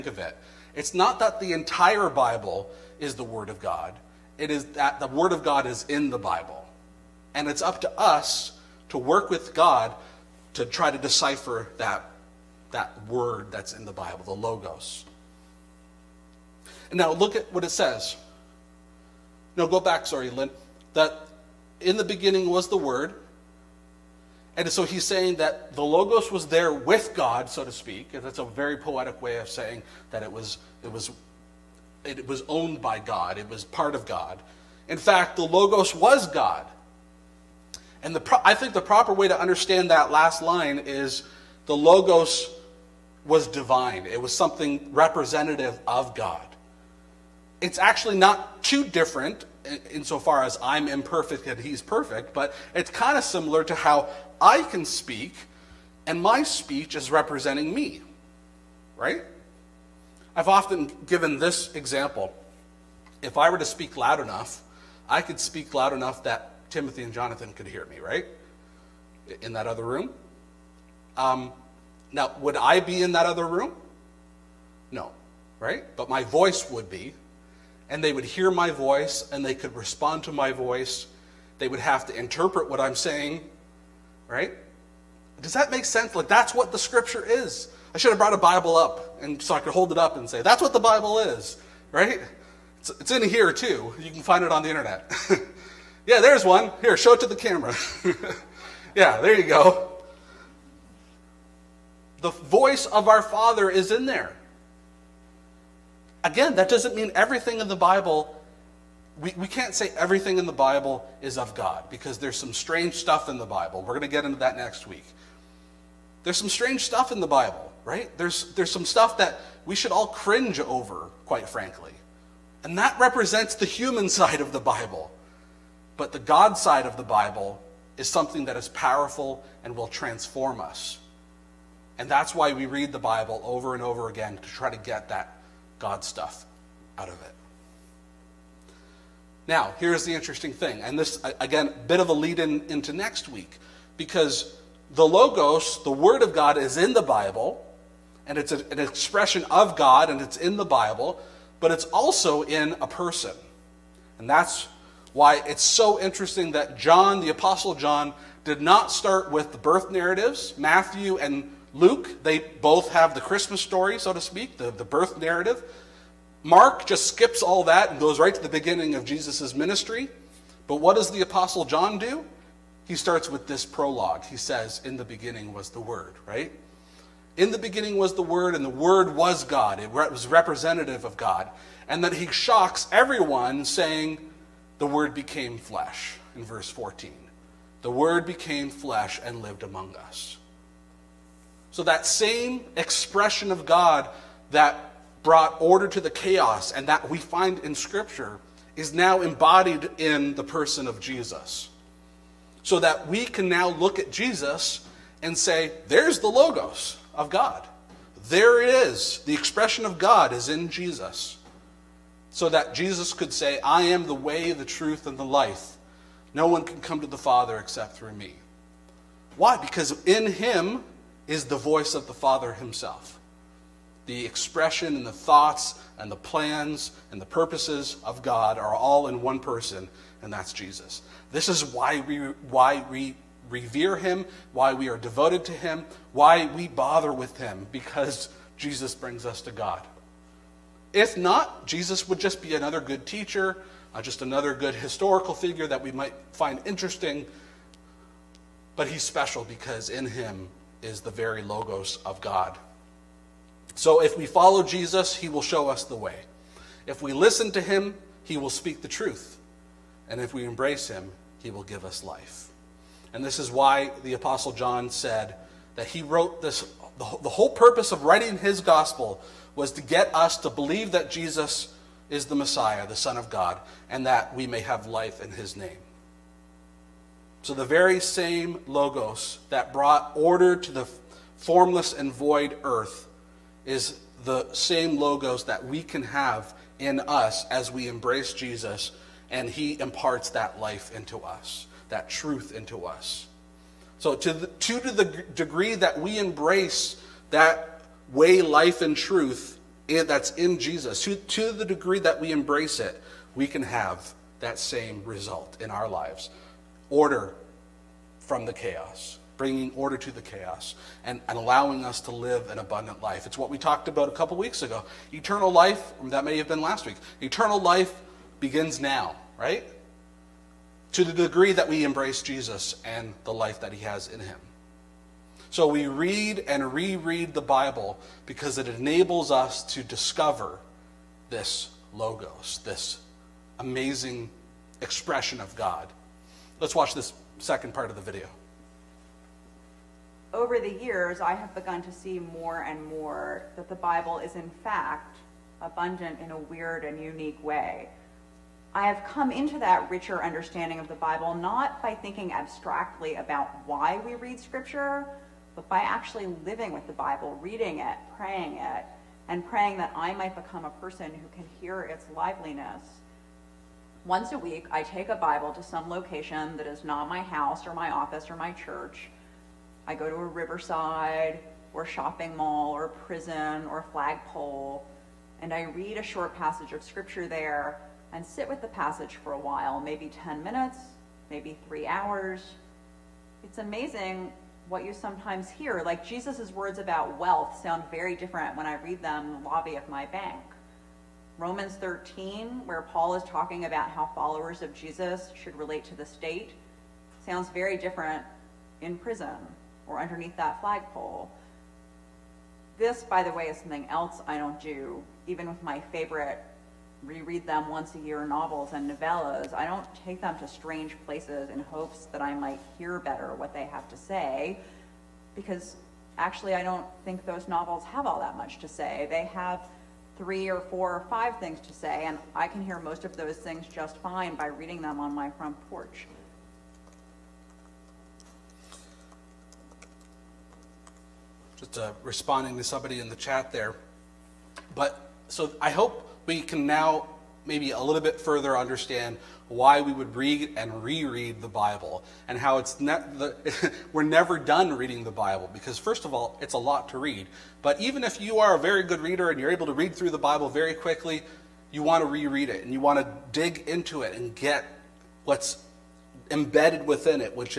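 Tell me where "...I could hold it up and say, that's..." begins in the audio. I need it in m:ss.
1:29.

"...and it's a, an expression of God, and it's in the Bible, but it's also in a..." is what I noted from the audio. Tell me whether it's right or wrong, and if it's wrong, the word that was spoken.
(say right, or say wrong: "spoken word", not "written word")
right.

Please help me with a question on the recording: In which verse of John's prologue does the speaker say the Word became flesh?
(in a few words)
Verse 14.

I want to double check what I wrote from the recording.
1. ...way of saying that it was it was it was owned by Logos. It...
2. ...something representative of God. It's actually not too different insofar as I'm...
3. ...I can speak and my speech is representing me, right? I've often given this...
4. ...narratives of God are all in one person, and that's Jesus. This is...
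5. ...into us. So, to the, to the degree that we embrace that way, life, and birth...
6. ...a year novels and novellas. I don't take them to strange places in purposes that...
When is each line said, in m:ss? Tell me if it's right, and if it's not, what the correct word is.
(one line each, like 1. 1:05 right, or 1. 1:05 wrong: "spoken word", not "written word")
1. 0:29 wrong: "God", not "Logos"
2. 0:44 right
3. 0:54 right
4. 3:47 wrong: "purposes", not "narratives"
5. 4:52 wrong: "truth", not "birth"
6. 6:47 wrong: "hopes", not "purposes".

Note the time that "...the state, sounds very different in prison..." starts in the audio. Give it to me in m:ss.
6:35.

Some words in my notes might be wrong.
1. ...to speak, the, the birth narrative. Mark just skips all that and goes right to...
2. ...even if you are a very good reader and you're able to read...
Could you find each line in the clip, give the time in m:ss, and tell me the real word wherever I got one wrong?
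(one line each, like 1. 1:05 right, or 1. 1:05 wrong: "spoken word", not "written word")
1. 2:44 right
2. 7:27 right.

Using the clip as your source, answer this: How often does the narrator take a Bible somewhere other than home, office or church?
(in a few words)
Once a week.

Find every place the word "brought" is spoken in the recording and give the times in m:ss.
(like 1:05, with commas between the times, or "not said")
1:28, 3:15, 4:39.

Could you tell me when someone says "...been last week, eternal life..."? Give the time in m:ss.
5:16.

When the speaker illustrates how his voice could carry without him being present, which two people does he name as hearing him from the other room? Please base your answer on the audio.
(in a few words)
Timothy and Jonathan.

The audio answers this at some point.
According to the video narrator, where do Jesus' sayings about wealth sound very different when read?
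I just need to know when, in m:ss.
6:29.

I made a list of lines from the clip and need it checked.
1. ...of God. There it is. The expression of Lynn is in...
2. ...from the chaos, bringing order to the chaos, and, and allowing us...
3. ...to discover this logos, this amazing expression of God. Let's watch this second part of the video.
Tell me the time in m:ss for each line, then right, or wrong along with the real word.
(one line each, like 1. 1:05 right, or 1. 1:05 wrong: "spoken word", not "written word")
1. 3:27 wrong: "God", not "Lynn"
2. 5:08 right
3. 5:29 right.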